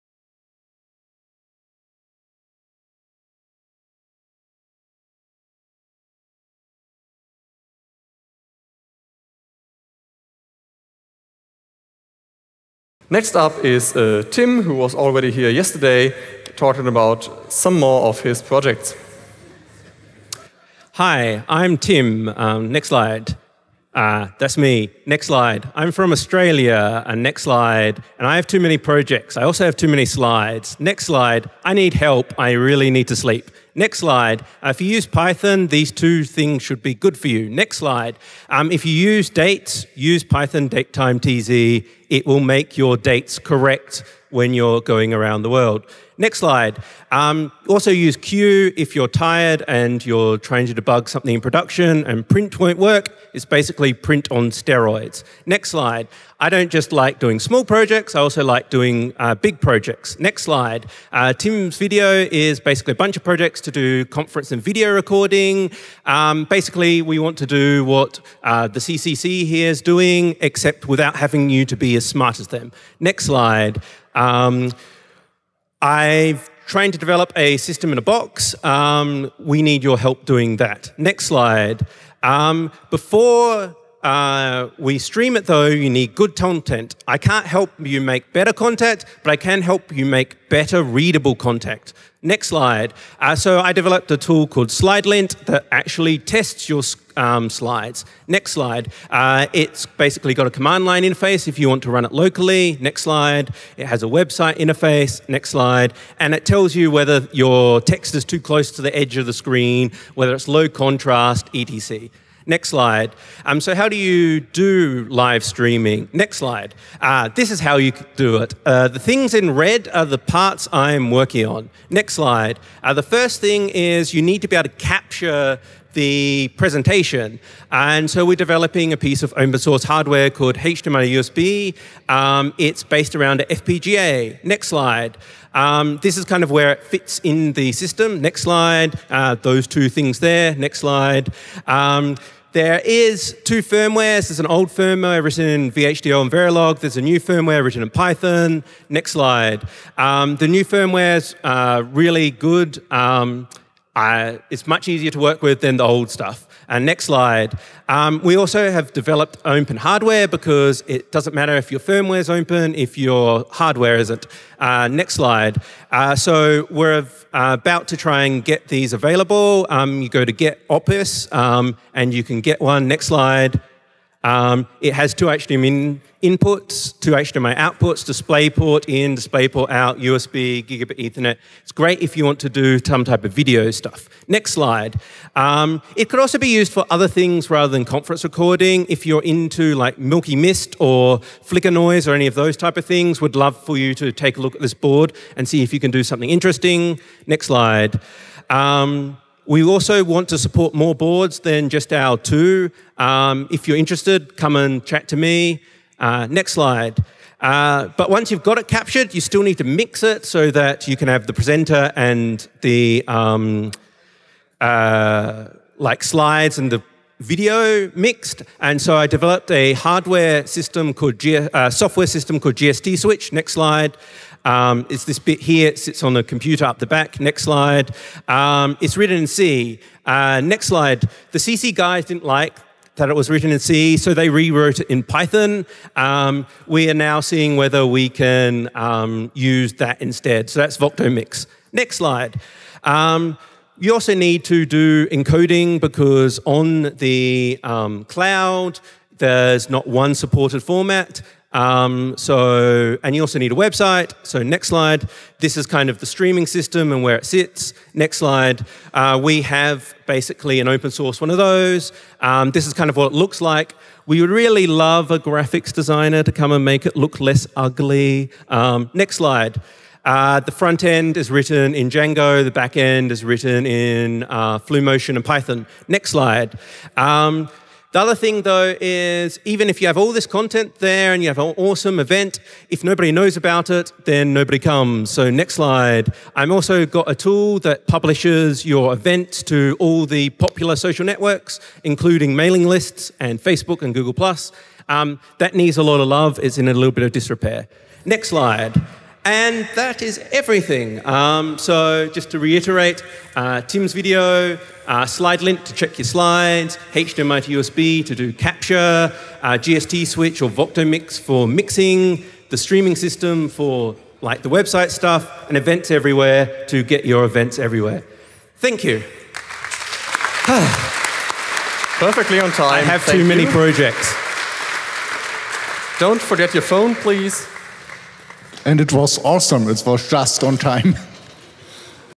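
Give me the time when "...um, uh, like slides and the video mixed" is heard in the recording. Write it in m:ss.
3:33.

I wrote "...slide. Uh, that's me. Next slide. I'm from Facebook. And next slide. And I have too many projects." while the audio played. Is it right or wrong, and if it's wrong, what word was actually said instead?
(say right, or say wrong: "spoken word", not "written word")
wrong: "Australia", not "Facebook".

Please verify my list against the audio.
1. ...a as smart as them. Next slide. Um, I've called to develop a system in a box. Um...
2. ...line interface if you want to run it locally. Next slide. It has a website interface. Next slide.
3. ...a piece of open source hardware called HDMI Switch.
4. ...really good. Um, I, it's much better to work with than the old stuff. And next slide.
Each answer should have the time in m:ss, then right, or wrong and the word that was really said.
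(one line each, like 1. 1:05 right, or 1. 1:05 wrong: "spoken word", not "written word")
1. 1:11 wrong: "trained", not "called"
2. 1:40 right
3. 2:08 wrong: "USB", not "Switch"
4. 2:31 wrong: "easier", not "better".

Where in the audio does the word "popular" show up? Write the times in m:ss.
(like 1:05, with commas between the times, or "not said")
4:50.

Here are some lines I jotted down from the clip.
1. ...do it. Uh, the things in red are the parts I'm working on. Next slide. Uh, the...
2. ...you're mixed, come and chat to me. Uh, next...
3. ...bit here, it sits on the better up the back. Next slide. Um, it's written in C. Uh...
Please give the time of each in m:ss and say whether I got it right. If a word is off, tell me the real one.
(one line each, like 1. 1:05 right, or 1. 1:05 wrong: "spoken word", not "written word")
1. 1:58 right
2. 3:23 wrong: "interested", not "mixed"
3. 3:45 wrong: "computer", not "better".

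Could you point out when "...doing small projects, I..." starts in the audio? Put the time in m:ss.
0:57.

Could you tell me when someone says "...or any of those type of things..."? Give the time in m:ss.
3:12.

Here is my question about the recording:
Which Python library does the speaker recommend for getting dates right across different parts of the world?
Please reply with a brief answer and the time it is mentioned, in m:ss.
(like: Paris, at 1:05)
Python tz, at 0:40.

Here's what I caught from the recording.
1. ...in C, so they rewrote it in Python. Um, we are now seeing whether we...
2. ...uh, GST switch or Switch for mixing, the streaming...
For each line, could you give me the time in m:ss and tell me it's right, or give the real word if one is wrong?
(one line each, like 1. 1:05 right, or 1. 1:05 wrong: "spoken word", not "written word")
1. 3:53 right
2. 5:09 wrong: "Voctomix", not "Switch".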